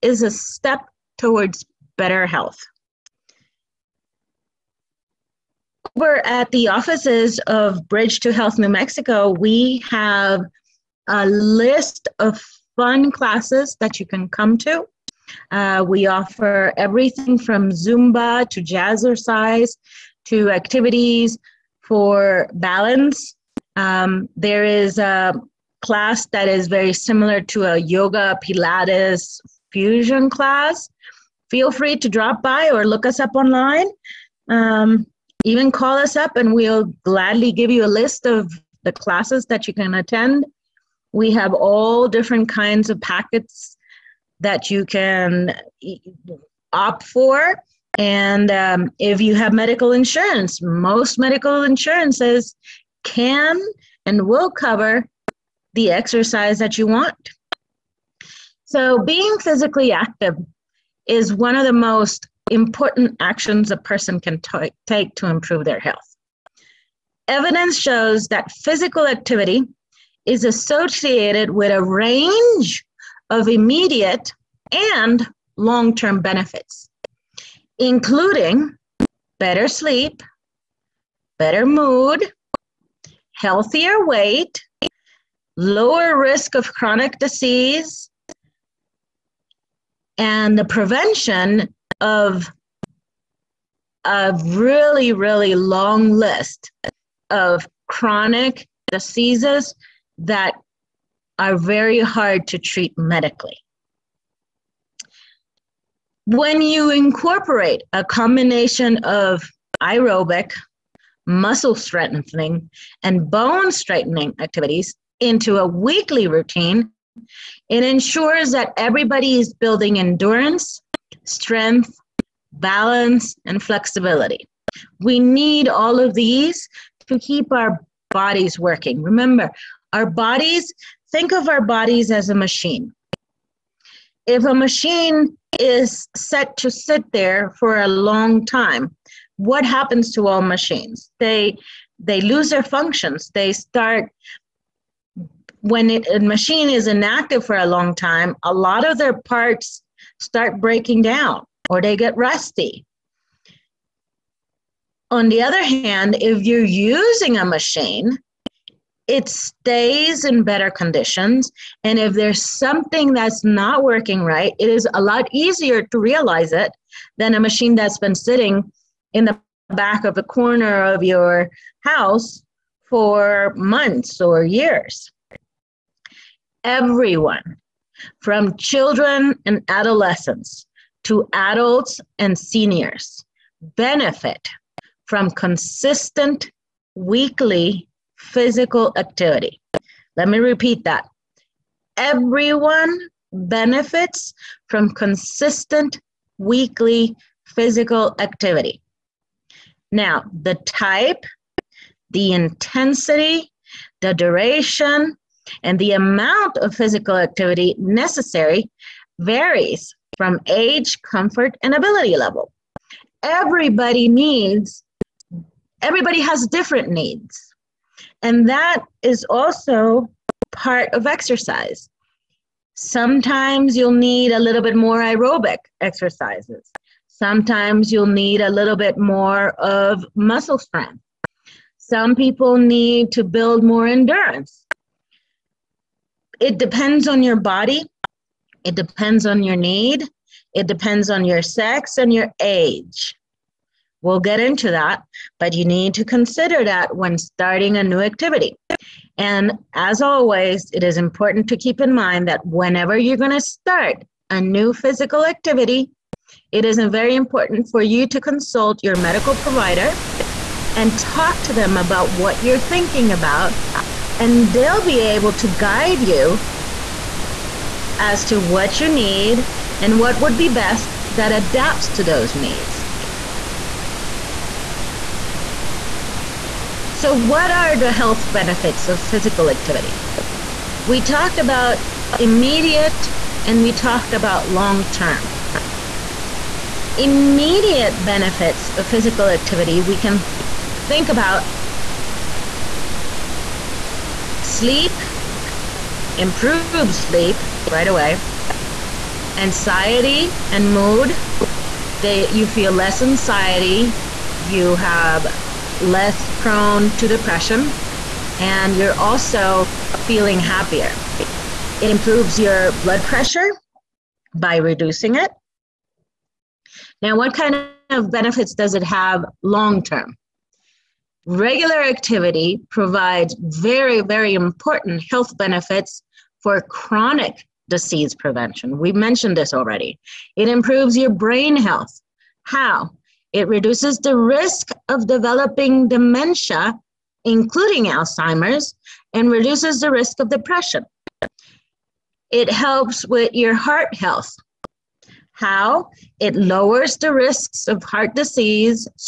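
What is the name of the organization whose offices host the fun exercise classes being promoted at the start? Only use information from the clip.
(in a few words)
Bridge to Health New Mexico.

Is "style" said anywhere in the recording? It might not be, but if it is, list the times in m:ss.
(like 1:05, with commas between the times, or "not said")
not said.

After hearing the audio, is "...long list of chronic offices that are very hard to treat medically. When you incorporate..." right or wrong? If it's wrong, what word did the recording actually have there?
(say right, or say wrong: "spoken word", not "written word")
wrong: "diseases", not "offices".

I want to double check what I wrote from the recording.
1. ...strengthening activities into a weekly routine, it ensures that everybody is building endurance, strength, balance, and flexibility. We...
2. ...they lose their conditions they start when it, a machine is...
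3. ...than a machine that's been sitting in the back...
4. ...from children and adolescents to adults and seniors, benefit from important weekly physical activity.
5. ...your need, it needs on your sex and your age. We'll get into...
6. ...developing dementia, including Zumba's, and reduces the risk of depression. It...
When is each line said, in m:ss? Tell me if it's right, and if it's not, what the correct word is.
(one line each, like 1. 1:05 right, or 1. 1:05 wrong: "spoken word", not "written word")
1. 1:53 right
2. 2:21 wrong: "functions", not "conditions"
3. 2:47 right
4. 2:58 wrong: "consistent", not "important"
5. 3:59 wrong: "depends", not "needs"
6. 5:35 wrong: "Alzheimer", not "Zumba".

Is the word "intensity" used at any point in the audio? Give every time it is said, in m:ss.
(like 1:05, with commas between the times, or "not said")
3:22.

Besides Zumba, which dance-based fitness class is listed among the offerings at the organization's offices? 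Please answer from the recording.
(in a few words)
jazzercise.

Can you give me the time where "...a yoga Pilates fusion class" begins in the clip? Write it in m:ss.
0:27.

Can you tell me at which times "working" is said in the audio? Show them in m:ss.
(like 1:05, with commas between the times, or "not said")
2:08, 2:43.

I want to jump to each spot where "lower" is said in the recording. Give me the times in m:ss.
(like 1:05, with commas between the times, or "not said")
1:25, 5:46.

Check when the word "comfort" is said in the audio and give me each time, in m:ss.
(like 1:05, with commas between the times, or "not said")
3:31.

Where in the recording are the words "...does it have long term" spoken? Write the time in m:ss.
5:18.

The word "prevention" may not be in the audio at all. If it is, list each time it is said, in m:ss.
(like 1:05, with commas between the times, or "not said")
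1:30, 5:28.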